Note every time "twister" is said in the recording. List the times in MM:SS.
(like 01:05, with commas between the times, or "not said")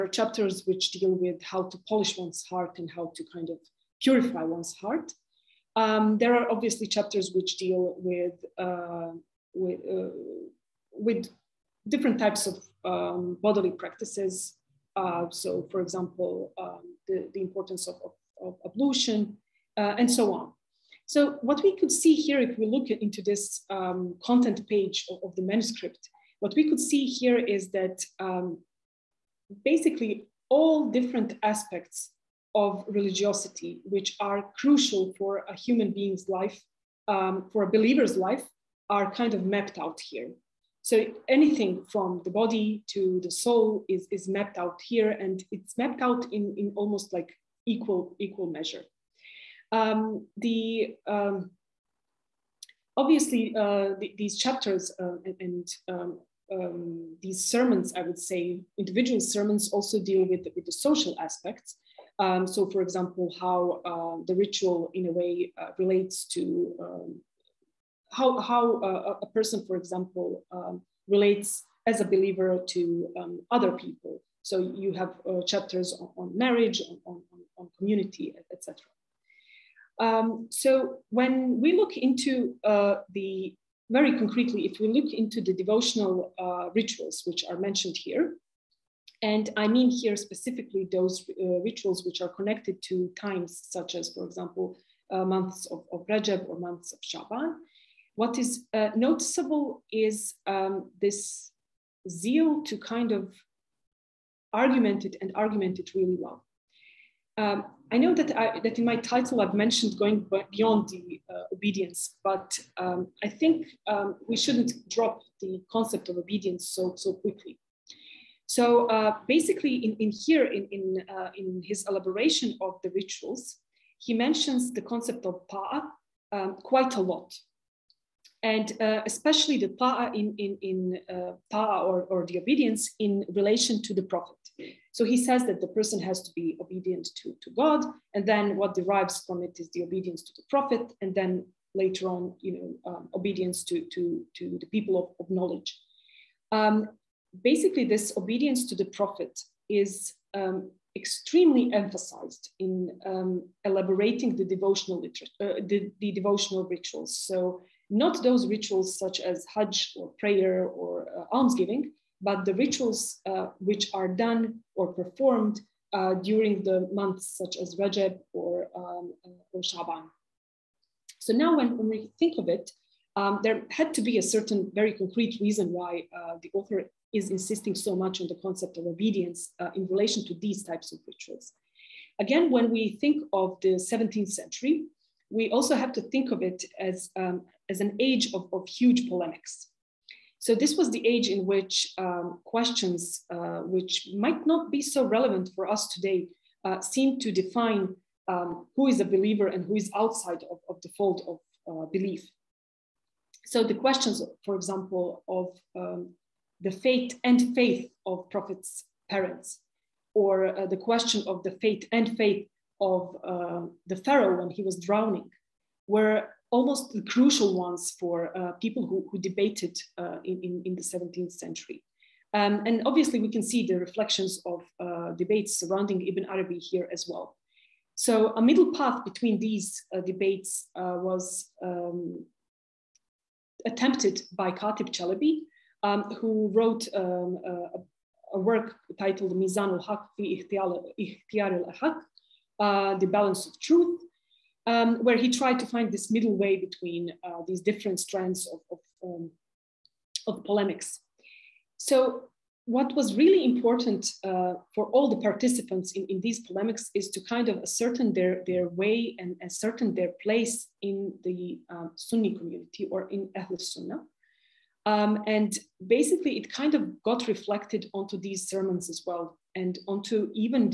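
not said.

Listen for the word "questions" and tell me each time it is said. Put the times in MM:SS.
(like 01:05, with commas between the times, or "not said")
03:12, 03:23, 03:30.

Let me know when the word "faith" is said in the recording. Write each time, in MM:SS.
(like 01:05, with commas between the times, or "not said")
03:27, 03:32.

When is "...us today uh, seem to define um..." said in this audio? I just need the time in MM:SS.
03:15.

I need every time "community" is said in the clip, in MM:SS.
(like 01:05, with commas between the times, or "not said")
01:17, 04:22.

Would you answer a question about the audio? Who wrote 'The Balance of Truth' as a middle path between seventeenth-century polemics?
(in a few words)
Katib Çelebi.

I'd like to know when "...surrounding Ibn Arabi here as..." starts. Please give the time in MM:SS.
03:45.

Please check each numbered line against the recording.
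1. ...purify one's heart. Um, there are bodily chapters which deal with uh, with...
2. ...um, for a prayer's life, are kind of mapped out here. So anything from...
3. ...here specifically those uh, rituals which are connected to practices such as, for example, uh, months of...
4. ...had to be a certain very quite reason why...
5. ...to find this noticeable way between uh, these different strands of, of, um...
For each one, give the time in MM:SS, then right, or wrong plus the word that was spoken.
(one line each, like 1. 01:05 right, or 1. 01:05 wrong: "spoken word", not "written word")
1. 00:04 wrong: "obviously", not "bodily"
2. 00:37 wrong: "believer", not "prayer"
3. 01:29 wrong: "times", not "practices"
4. 02:53 wrong: "concrete", not "quite"
5. 04:05 wrong: "middle", not "noticeable".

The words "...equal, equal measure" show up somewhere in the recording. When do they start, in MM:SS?
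00:47.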